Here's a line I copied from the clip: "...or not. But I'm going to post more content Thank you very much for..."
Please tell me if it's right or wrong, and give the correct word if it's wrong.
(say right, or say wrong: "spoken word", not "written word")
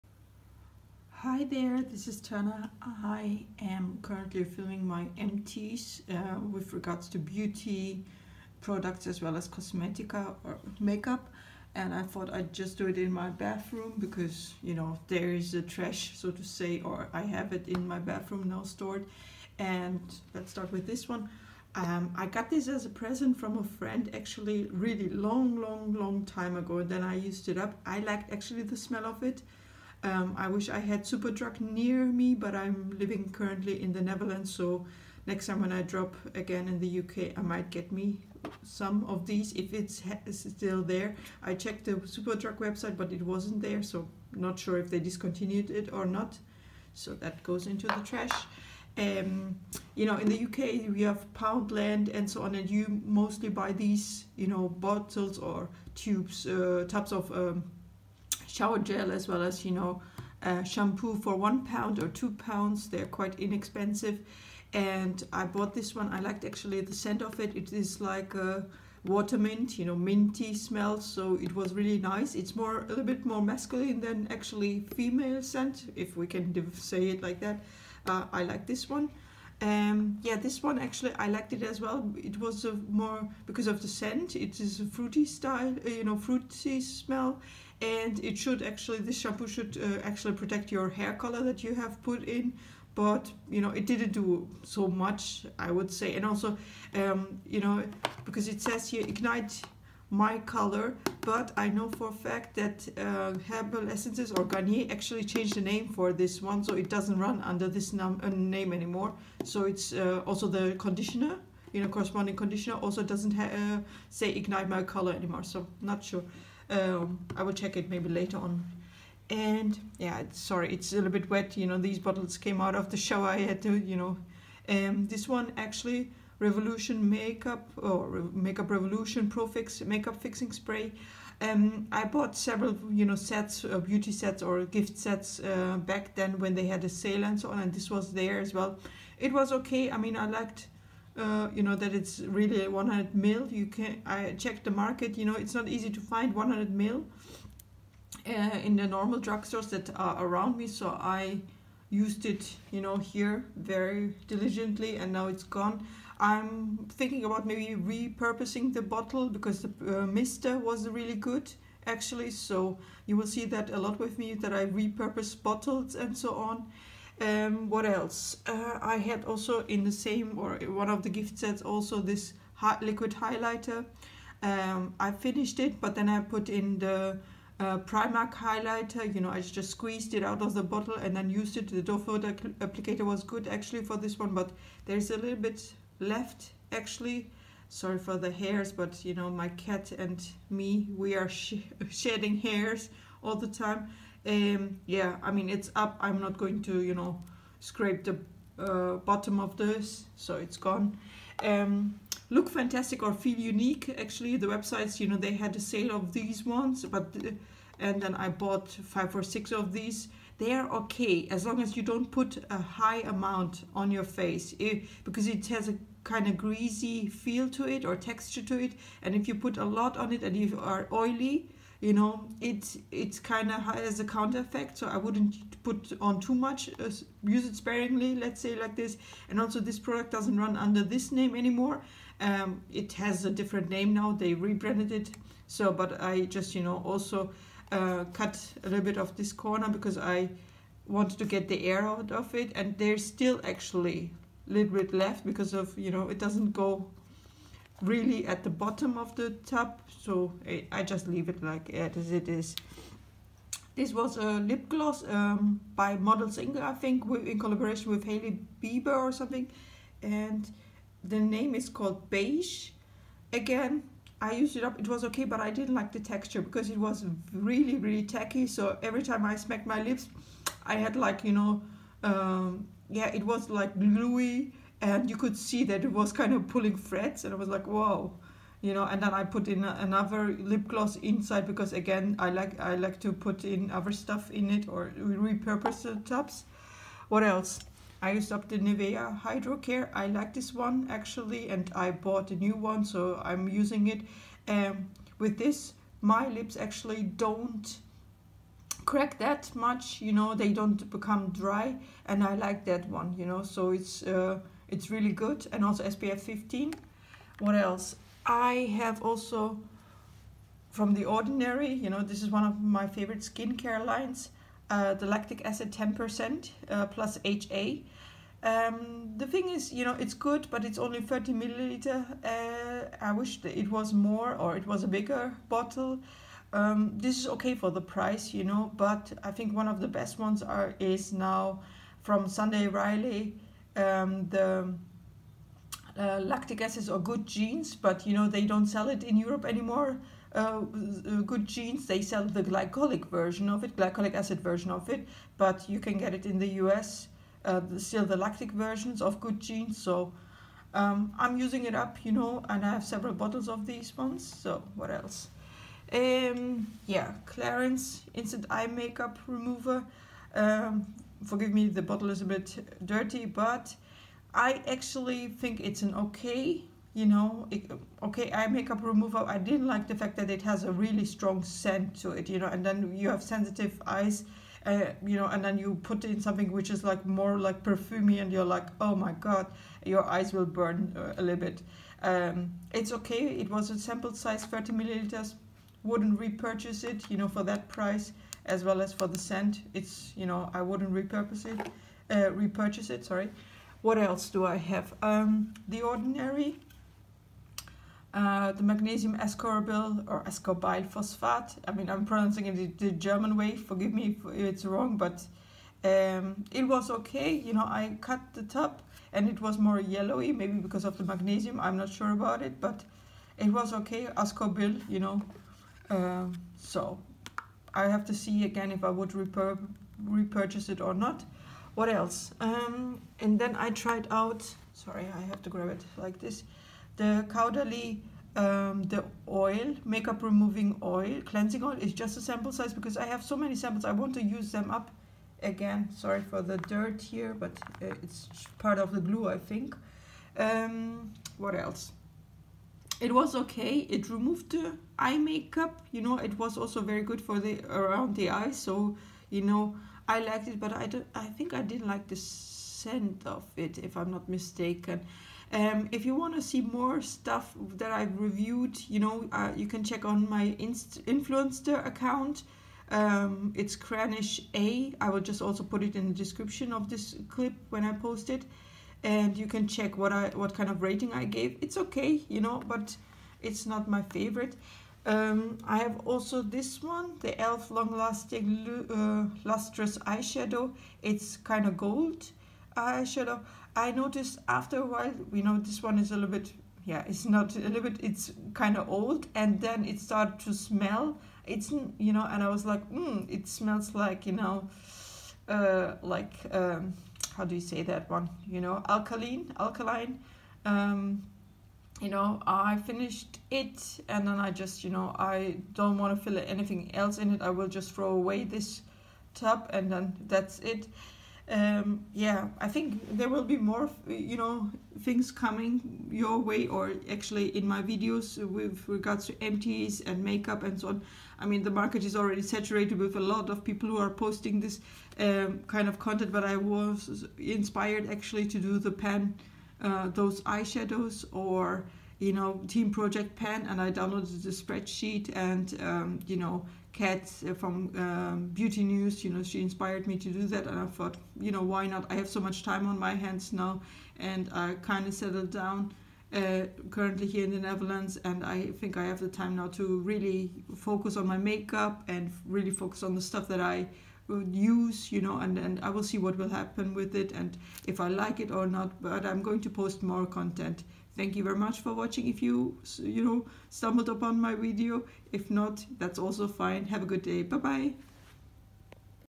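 right.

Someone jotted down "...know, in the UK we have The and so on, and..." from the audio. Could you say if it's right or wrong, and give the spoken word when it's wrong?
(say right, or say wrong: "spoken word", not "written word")
wrong: "Poundland", not "The".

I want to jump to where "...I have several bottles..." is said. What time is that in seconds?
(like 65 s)
352 s.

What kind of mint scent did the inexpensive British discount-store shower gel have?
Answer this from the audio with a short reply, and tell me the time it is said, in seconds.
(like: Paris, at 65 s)
Water mint, at 69 s.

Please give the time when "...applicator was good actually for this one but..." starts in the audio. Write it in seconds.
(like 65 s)
182 s.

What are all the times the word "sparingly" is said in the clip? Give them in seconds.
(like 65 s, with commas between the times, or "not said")
227 s.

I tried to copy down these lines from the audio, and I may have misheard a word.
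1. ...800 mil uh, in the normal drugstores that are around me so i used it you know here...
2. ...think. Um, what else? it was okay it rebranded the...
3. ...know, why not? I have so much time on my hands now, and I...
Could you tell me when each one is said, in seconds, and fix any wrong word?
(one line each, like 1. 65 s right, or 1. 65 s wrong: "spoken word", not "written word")
1. 146 s wrong: "100", not "800"
2. 439 s wrong: "removed", not "rebranded"
3. 541 s right.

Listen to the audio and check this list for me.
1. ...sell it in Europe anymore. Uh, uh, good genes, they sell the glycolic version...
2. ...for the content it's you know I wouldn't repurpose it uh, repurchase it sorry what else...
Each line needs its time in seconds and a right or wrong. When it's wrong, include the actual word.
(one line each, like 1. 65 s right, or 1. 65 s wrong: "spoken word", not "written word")
1. 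338 s right
2. 388 s wrong: "scent", not "content".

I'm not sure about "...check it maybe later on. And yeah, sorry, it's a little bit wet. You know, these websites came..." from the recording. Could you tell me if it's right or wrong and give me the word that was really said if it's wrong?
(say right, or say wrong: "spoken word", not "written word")
wrong: "bottles", not "websites".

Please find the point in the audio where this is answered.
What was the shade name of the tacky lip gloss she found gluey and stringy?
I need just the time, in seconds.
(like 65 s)
262 s.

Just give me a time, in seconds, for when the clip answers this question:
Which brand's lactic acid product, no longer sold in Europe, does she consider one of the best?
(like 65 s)
332 s.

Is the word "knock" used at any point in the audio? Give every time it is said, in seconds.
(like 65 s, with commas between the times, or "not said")
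not said.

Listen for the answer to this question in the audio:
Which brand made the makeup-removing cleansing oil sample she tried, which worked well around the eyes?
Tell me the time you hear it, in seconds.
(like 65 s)
427 s.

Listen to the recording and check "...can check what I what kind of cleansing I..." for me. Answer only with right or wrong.
wrong.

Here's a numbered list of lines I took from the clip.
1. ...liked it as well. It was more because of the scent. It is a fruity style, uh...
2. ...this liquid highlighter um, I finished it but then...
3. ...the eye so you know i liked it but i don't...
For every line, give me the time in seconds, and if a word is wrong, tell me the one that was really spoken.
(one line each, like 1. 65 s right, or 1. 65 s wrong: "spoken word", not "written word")
1. 81 s right
2. 172 s right
3. 448 s right.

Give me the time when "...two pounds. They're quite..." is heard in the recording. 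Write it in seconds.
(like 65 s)
62 s.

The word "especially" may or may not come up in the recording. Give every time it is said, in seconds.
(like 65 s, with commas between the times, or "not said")
not said.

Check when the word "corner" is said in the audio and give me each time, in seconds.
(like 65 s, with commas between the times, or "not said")
239 s.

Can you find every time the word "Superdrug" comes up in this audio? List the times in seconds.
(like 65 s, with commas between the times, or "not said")
31 s, 41 s.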